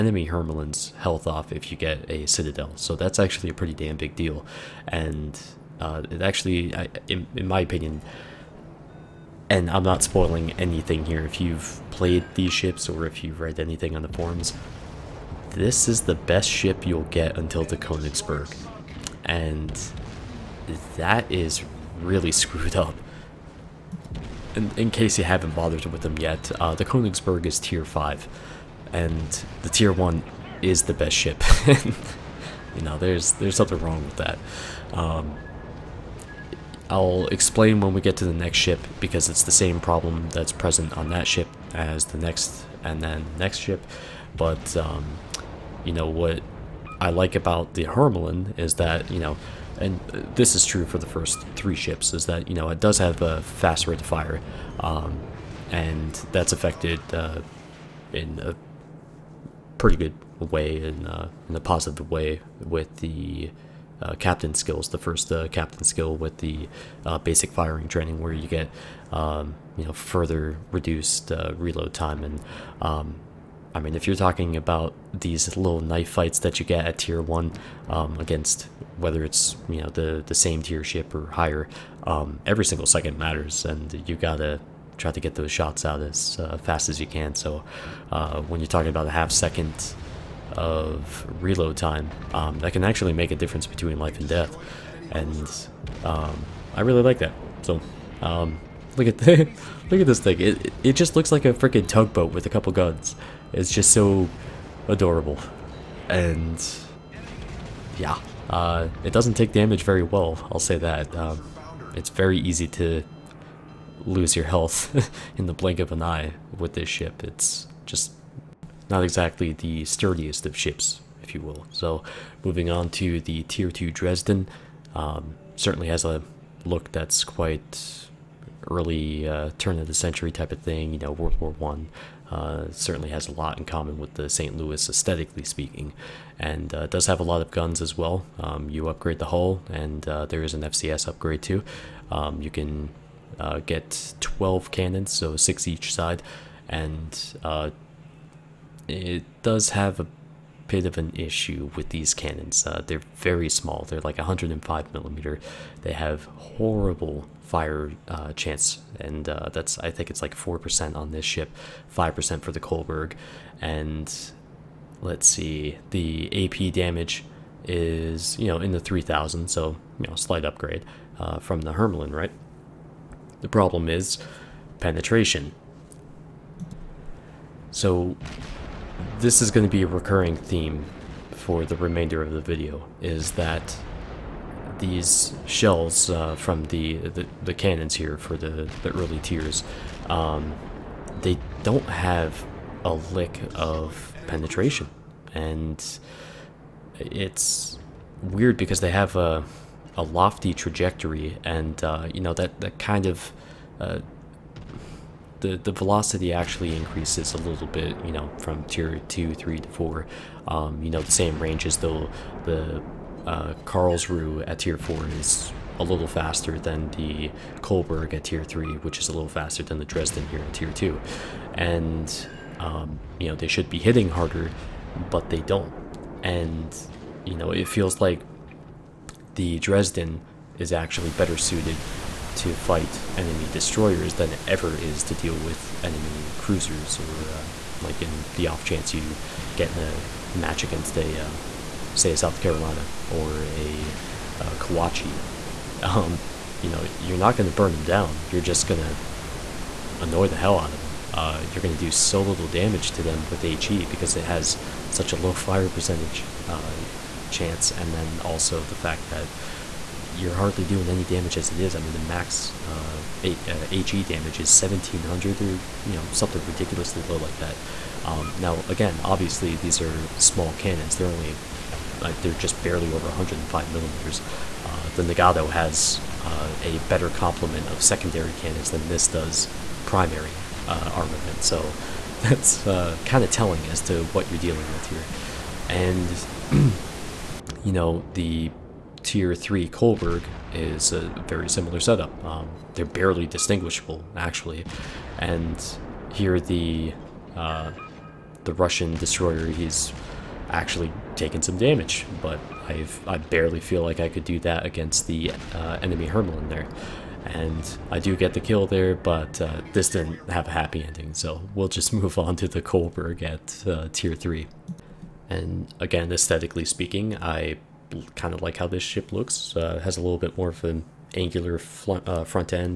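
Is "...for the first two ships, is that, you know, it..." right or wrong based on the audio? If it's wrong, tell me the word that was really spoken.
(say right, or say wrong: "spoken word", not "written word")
wrong: "three", not "two".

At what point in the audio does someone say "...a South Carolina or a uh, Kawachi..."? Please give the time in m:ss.
4:02.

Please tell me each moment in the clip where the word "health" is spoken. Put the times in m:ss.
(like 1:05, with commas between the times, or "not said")
0:00, 1:54.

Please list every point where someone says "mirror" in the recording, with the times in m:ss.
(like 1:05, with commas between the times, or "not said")
not said.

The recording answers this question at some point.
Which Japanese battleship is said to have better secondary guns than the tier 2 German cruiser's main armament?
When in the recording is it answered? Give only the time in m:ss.
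4:35.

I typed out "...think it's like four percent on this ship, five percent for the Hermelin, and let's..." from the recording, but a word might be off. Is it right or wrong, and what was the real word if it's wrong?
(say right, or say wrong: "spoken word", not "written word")
wrong: "Kolberg", not "Hermelin".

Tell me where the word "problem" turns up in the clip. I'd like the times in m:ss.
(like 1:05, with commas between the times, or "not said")
0:39, 2:53.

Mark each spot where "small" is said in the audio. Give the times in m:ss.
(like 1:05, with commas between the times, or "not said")
2:33, 4:30.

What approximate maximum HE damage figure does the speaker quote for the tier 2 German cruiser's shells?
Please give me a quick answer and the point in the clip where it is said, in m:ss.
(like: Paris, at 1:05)
1700, at 4:24.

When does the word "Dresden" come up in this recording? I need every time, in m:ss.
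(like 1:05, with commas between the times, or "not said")
2:03, 3:39, 3:49.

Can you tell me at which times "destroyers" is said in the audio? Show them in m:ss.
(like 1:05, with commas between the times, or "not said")
3:53, 4:58.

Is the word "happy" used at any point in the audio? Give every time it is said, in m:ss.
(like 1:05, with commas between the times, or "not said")
5:10.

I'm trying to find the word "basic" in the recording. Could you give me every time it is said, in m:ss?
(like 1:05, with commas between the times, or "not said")
1:07.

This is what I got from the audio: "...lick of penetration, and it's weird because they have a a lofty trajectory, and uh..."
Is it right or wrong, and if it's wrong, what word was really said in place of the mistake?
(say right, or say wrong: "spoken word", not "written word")
right.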